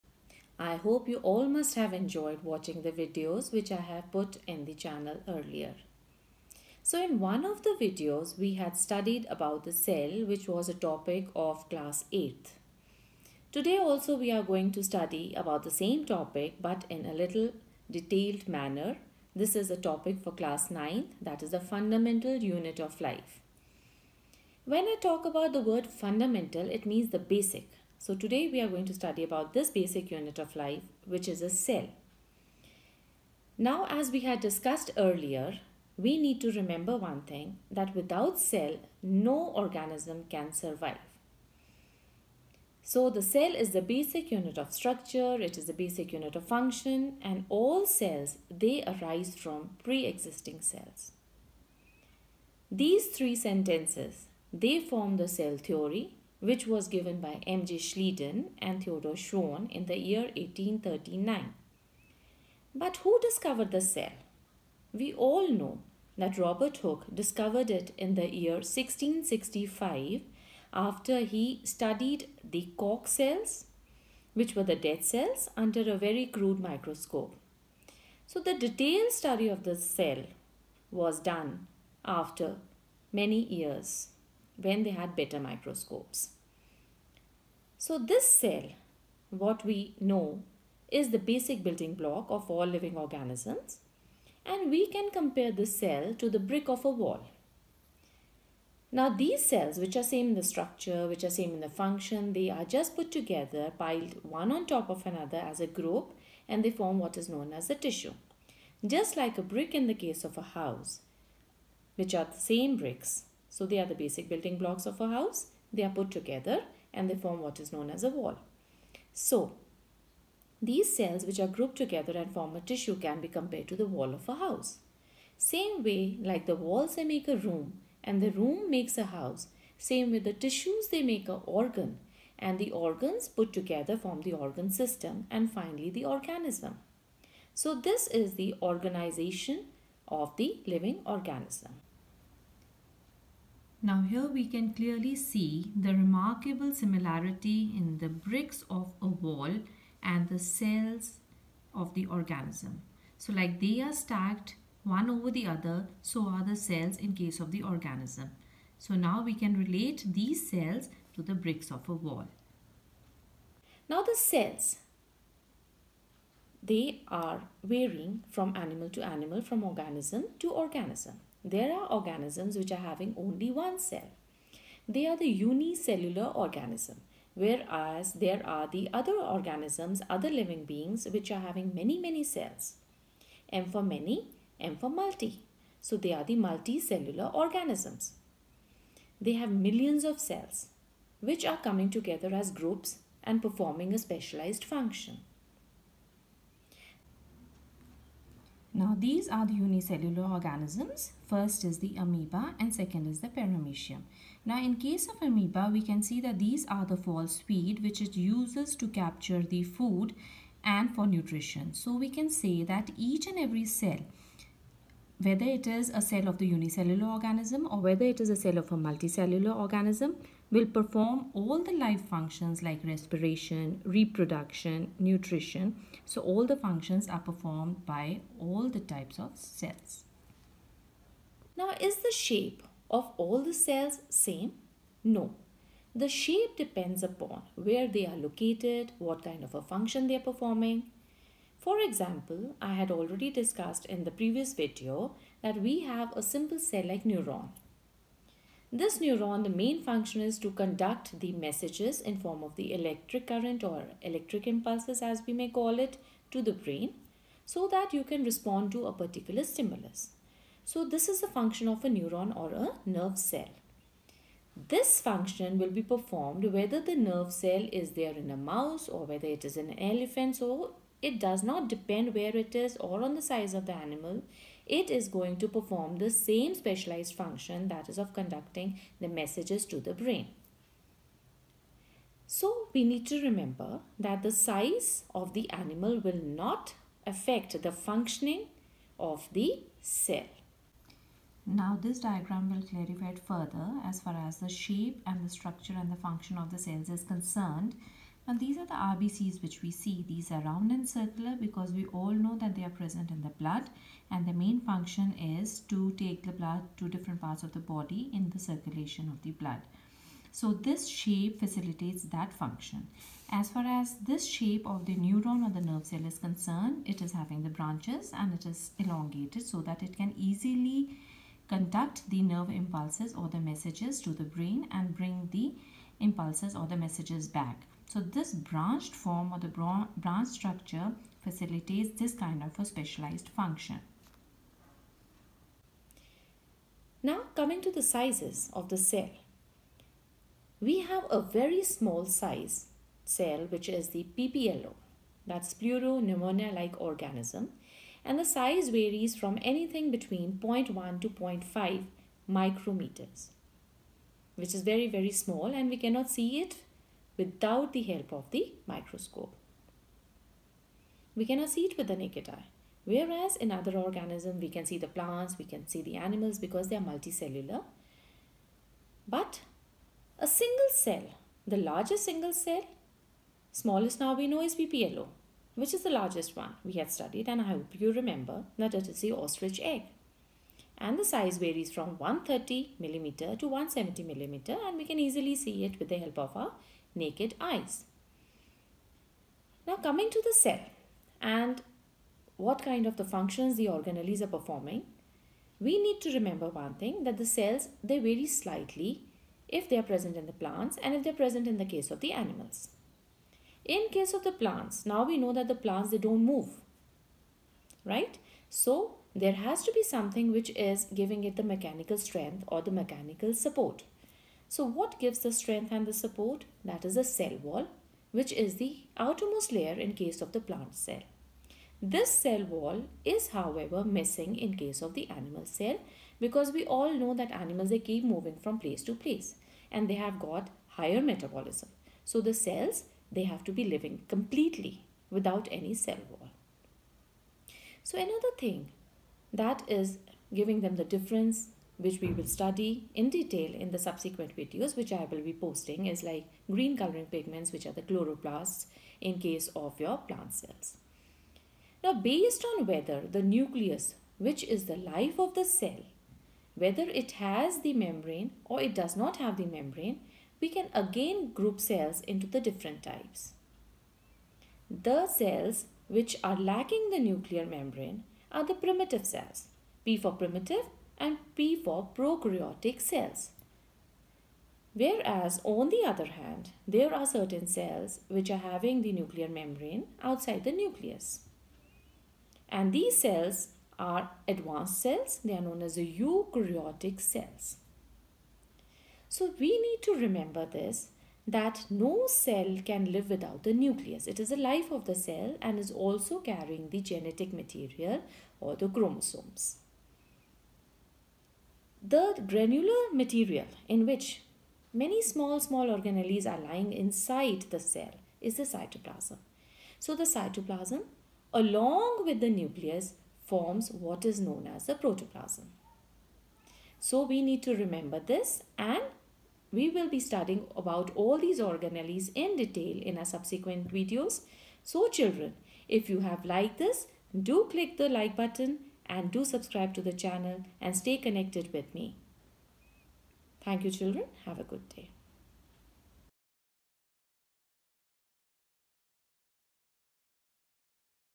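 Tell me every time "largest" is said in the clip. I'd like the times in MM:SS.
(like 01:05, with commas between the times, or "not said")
06:11, 06:16.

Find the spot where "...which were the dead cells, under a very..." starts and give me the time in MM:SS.
01:14.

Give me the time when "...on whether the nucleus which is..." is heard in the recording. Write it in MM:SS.
07:32.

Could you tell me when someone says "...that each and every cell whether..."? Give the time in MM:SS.
03:32.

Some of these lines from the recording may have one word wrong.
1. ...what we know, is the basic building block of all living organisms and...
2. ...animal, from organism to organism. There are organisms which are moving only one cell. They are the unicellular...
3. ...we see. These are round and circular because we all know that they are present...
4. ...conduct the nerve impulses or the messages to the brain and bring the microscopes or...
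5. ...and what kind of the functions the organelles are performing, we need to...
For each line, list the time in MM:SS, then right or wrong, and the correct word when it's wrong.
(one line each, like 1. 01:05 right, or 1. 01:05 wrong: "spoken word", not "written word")
1. 01:29 right
2. 02:49 wrong: "having", not "moving"
3. 04:59 right
4. 05:21 wrong: "impulses", not "microscopes"
5. 06:31 right.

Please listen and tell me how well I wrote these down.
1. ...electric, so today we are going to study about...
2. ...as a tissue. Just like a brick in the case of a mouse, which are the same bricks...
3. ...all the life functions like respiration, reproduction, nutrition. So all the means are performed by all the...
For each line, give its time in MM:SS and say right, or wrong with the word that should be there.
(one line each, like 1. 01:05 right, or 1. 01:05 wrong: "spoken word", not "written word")
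1. 00:27 wrong: "basic", not "electric"
2. 01:47 wrong: "house", not "mouse"
3. 03:41 wrong: "functions", not "means".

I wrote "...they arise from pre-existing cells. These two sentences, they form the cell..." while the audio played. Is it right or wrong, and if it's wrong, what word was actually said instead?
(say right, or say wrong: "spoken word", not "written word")
wrong: "three", not "two".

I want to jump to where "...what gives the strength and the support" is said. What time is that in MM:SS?
06:54.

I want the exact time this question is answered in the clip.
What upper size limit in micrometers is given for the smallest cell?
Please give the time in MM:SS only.
05:51.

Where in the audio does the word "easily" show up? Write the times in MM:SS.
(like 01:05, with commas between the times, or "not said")
05:20, 06:25.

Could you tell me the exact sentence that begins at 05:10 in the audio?
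So this shape facilitates that function.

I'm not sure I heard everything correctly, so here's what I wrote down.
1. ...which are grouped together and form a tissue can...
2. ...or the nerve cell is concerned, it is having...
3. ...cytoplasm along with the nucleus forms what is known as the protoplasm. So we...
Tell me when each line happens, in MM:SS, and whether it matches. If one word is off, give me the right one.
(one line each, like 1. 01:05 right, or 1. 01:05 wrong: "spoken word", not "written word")
1. 02:01 right
2. 05:15 right
3. 08:30 right.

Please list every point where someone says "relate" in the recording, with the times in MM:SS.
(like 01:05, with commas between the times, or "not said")
02:39.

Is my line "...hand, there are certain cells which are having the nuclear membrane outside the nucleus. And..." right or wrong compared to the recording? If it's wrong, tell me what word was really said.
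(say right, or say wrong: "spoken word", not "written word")
right.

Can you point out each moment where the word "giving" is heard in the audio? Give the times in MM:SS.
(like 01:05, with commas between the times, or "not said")
06:50, 07:20.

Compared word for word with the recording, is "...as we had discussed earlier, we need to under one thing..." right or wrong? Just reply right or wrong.
wrong.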